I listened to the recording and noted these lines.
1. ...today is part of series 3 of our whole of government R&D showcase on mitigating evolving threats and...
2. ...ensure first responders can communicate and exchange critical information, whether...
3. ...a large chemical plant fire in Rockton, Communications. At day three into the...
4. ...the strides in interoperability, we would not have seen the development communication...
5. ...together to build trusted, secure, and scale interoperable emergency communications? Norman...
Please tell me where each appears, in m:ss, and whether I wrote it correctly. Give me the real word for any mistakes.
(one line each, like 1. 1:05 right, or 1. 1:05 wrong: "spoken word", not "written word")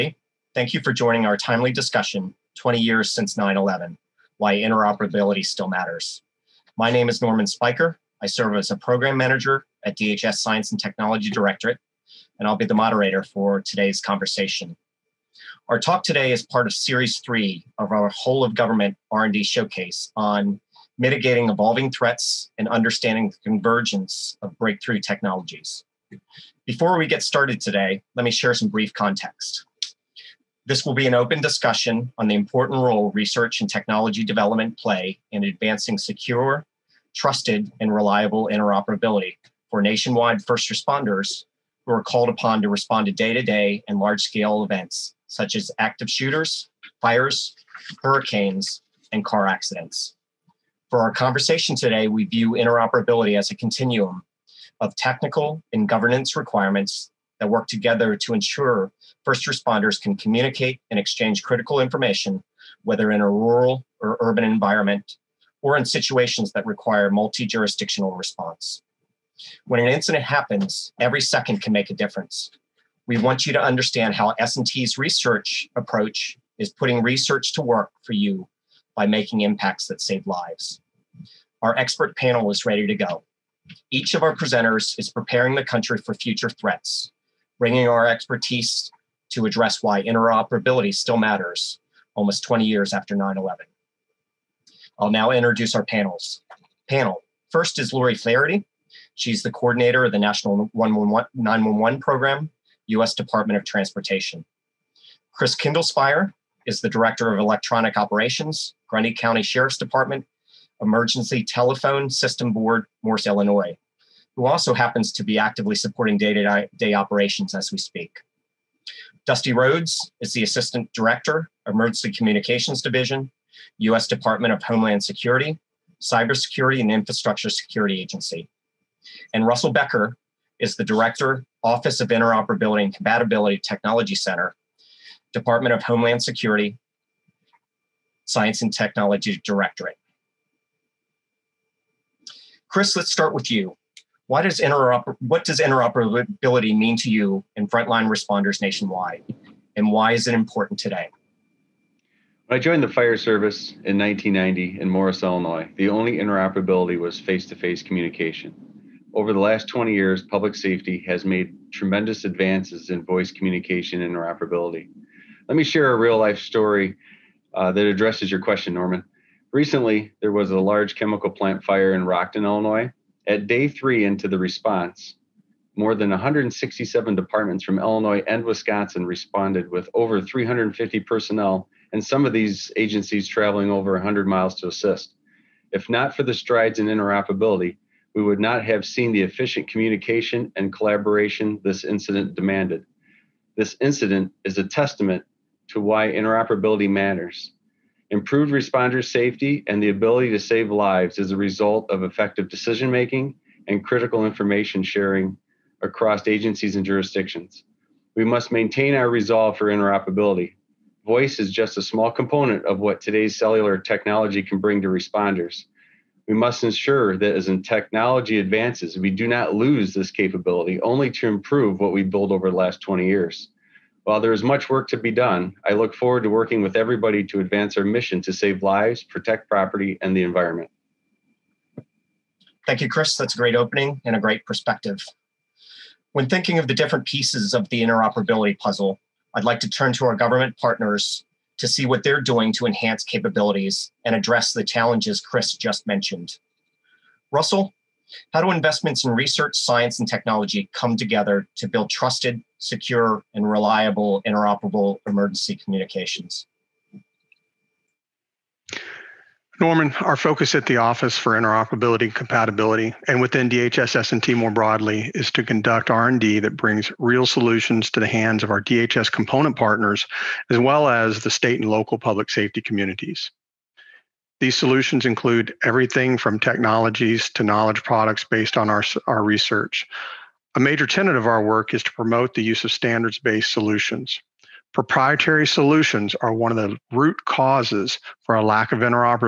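1. 0:16 right
2. 0:58 right
3. 2:50 wrong: "Illinois", not "Communications"
4. 3:06 wrong: "efficient", not "development"
5. 4:10 wrong: "reliable", not "scale".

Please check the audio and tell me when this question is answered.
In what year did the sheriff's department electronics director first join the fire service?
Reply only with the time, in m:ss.
2:33.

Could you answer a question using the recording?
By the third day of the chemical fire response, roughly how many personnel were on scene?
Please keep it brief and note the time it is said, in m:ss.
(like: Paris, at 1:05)
350, at 3:00.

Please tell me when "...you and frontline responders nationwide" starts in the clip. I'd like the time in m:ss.
2:27.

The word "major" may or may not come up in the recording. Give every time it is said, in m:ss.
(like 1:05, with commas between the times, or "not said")
4:40.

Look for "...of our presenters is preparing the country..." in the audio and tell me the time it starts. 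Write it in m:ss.
1:24.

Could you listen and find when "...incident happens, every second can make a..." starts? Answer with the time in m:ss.
1:09.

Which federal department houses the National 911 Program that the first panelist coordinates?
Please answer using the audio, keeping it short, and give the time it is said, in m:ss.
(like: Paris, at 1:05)
U.S. Department of Transportation, at 1:42.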